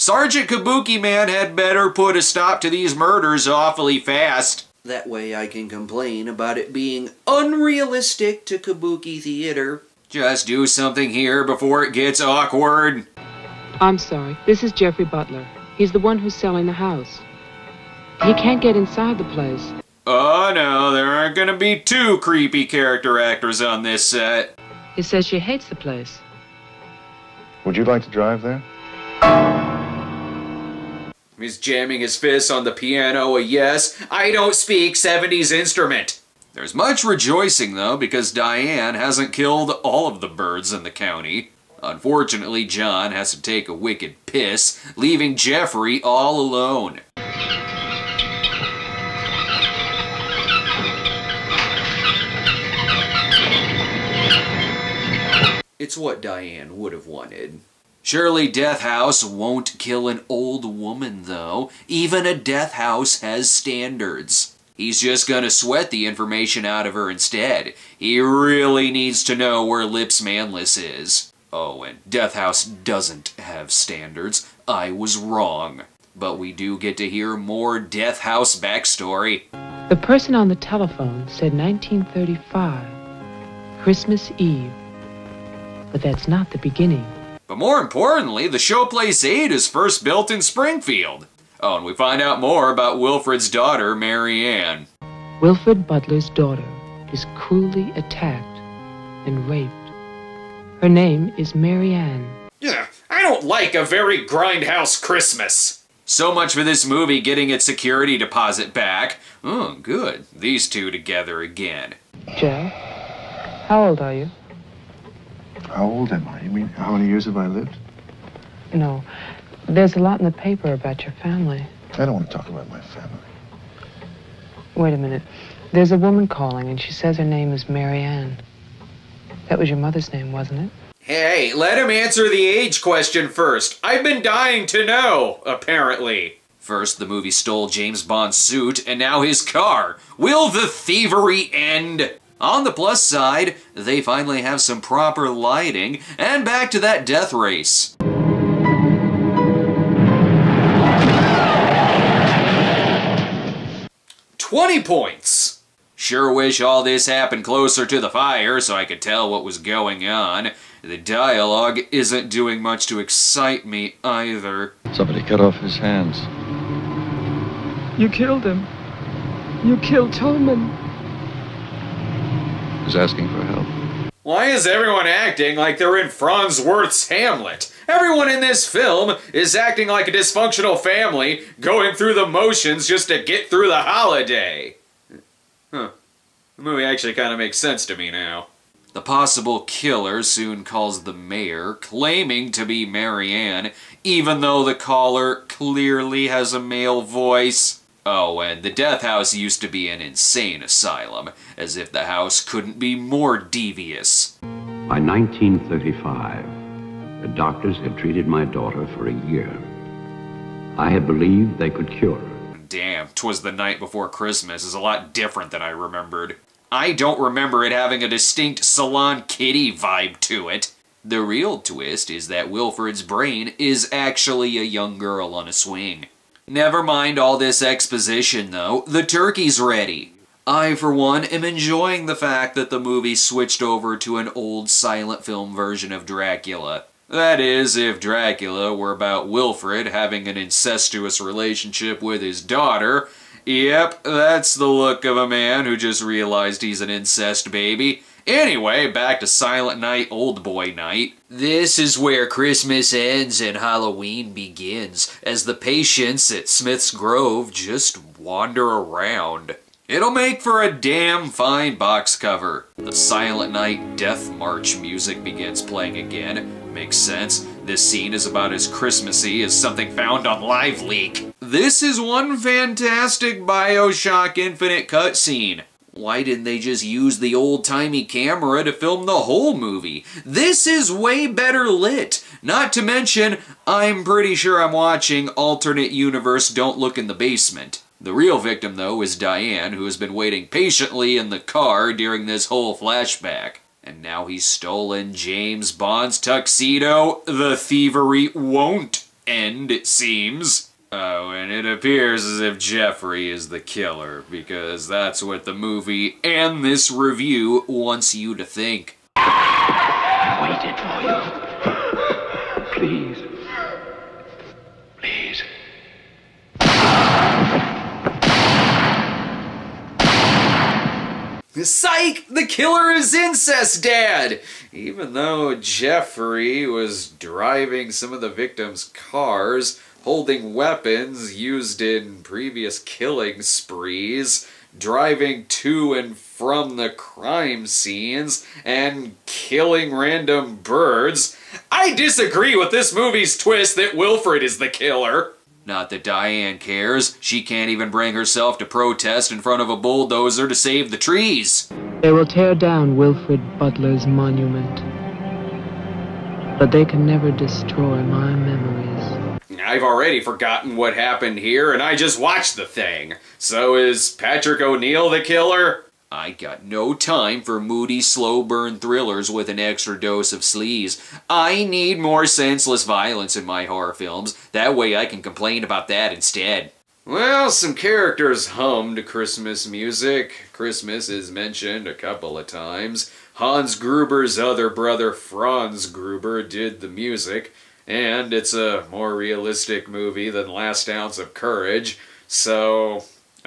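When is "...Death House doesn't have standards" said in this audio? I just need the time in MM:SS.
01:12.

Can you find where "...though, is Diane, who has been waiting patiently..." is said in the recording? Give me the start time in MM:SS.
04:48.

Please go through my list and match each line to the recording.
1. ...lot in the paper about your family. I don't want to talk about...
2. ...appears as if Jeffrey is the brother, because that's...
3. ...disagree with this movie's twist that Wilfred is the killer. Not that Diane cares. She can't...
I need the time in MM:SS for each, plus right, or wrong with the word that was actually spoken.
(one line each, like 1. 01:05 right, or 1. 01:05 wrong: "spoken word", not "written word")
1. 01:59 right
2. 05:01 wrong: "killer", not "brother"
3. 05:41 right.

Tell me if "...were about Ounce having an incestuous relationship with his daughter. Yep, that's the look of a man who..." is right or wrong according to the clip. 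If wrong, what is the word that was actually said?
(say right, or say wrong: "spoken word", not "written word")
wrong: "Wilfred", not "Ounce".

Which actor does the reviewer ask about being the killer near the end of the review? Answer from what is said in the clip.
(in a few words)
Patrick O'Neal.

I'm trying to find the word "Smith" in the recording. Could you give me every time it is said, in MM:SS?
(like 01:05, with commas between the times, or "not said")
04:16.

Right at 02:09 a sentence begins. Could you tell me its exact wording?
That was your mother's name, wasn't it?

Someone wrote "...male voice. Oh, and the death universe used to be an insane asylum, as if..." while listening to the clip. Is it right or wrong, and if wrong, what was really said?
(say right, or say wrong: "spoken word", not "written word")
wrong: "house", not "universe".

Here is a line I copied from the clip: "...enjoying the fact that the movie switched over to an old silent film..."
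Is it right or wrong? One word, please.
right.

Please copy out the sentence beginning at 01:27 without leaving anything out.
But more importantly, the Showplace 8 is first built in Springfield.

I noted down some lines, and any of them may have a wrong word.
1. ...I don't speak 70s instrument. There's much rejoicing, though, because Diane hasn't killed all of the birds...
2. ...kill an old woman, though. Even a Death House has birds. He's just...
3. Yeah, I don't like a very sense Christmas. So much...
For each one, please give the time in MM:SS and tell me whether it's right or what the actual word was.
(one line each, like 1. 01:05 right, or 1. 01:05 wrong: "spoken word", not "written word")
1. 00:34 right
2. 00:59 wrong: "standards", not "birds"
3. 01:42 wrong: "grindhouse", not "sense".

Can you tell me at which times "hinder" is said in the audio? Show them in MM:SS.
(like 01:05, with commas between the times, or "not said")
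not said.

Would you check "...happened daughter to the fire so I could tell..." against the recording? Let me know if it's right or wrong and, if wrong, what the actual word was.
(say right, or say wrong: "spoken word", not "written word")
wrong: "closer", not "daughter".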